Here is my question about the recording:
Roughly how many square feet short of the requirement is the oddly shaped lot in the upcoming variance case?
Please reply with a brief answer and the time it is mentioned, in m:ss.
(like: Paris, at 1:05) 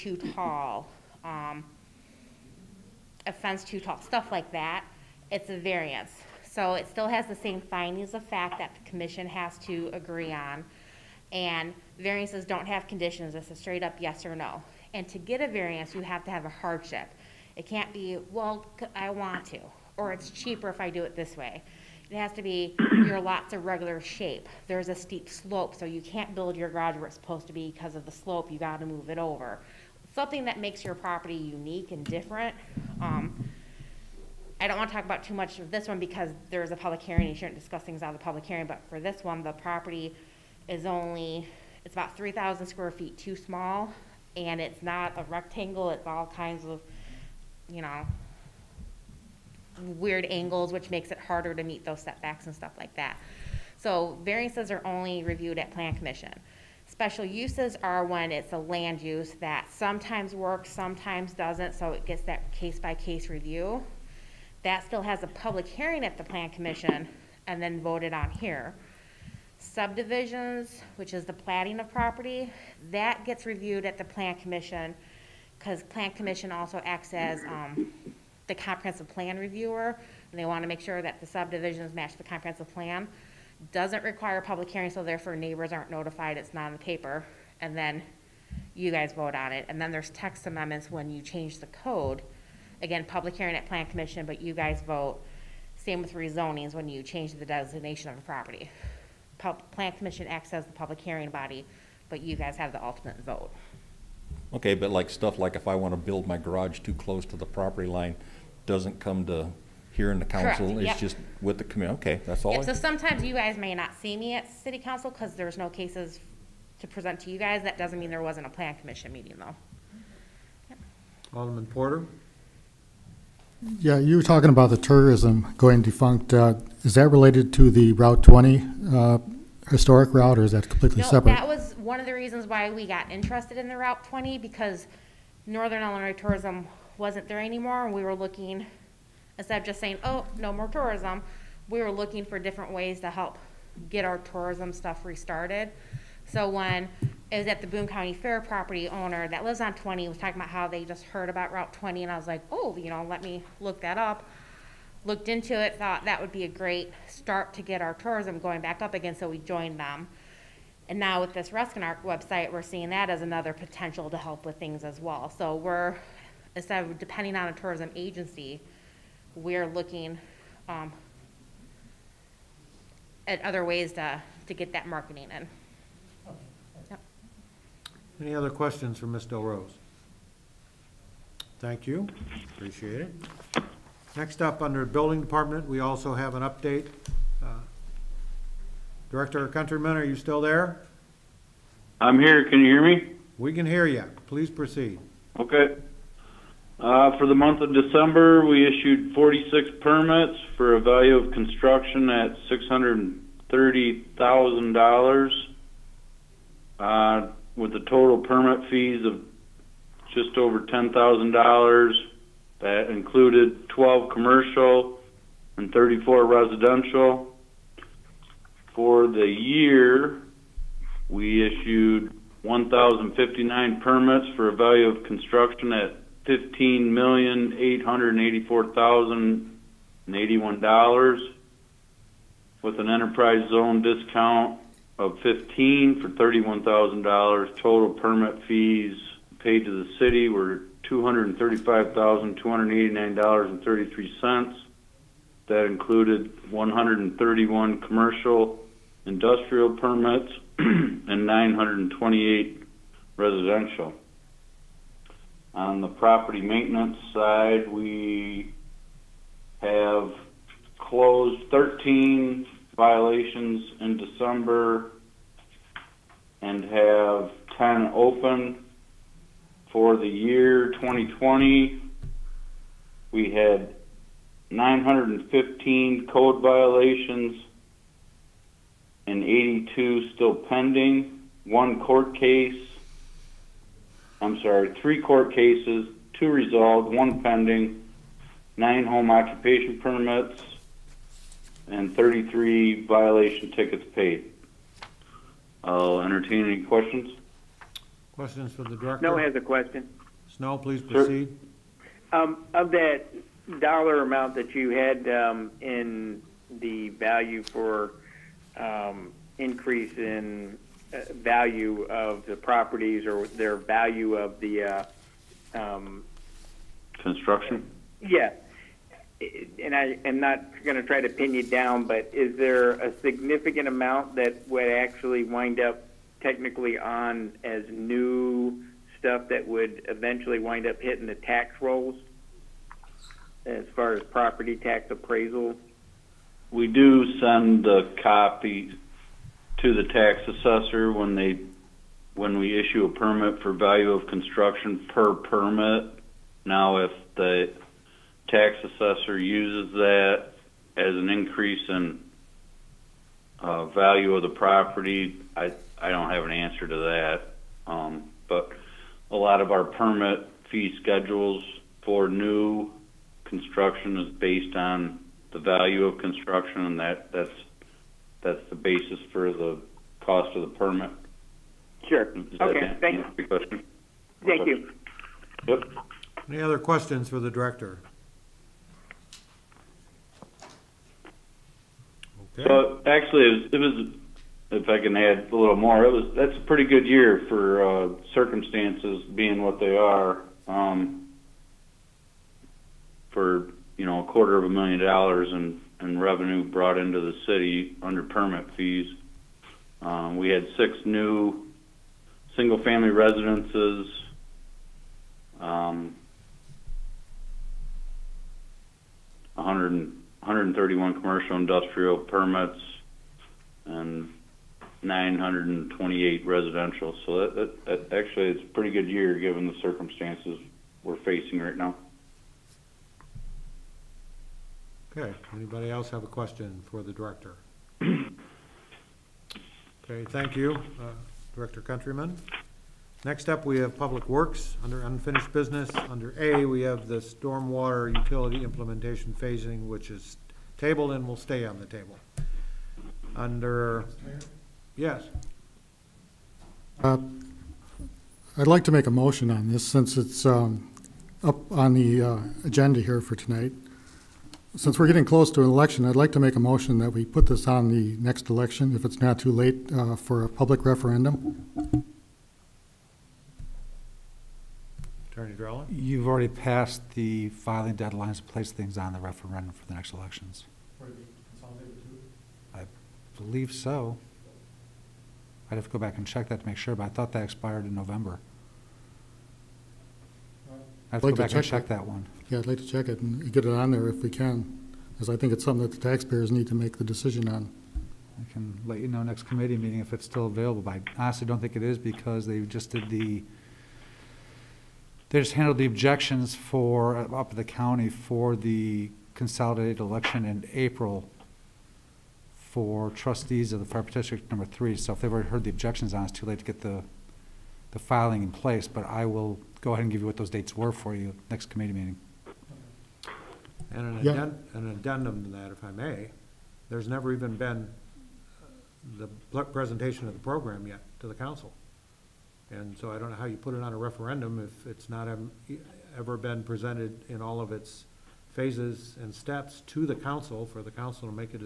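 3,000, at 0:42.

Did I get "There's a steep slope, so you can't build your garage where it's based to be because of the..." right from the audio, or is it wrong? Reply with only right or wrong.
wrong.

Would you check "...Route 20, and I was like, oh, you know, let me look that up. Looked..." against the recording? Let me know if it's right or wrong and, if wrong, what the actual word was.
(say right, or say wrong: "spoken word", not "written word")
right.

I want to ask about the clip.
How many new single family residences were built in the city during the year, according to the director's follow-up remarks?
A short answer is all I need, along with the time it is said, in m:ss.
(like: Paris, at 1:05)
6, at 6:40.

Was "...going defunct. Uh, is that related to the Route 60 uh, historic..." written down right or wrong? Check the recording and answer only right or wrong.
wrong.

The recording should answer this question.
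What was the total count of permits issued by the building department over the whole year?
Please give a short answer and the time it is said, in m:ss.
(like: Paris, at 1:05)
1,059, at 3:42.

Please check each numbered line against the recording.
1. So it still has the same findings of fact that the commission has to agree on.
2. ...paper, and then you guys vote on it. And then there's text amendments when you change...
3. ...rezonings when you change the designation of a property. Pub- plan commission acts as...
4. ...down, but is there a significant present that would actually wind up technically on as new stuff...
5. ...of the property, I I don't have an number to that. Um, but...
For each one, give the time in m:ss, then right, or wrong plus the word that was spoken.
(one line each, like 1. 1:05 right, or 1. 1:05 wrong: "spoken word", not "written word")
1. 0:06 right
2. 1:26 right
3. 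1:36 right
4. 5:21 wrong: "amount", not "present"
5. 5:54 wrong: "answer", not "number".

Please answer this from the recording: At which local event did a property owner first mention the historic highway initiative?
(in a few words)
Boone County Fair.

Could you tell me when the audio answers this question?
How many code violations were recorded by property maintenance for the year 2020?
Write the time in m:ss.
4:34.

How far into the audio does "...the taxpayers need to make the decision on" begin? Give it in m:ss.
8:05.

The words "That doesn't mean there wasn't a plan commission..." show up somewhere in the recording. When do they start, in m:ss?
1:57.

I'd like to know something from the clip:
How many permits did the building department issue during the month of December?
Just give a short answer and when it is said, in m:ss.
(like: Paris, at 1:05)
46, at 3:19.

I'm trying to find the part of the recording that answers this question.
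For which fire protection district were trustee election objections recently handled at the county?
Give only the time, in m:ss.
8:23.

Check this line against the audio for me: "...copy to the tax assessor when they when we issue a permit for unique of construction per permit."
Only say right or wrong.
wrong.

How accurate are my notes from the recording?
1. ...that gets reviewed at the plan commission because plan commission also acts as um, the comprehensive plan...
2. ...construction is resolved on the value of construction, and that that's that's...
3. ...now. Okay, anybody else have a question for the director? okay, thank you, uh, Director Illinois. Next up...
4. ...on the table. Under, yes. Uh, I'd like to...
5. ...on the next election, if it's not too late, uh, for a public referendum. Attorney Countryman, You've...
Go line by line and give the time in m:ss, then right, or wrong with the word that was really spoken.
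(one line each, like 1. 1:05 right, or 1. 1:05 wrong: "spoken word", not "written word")
1. 1:12 right
2. 6:03 wrong: "based", not "resolved"
3. 7:01 wrong: "Countryman", not "Illinois"
4. 7:21 right
5. 7:37 wrong: "Drella", not "Countryman".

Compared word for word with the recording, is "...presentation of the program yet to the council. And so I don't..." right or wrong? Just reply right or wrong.
right.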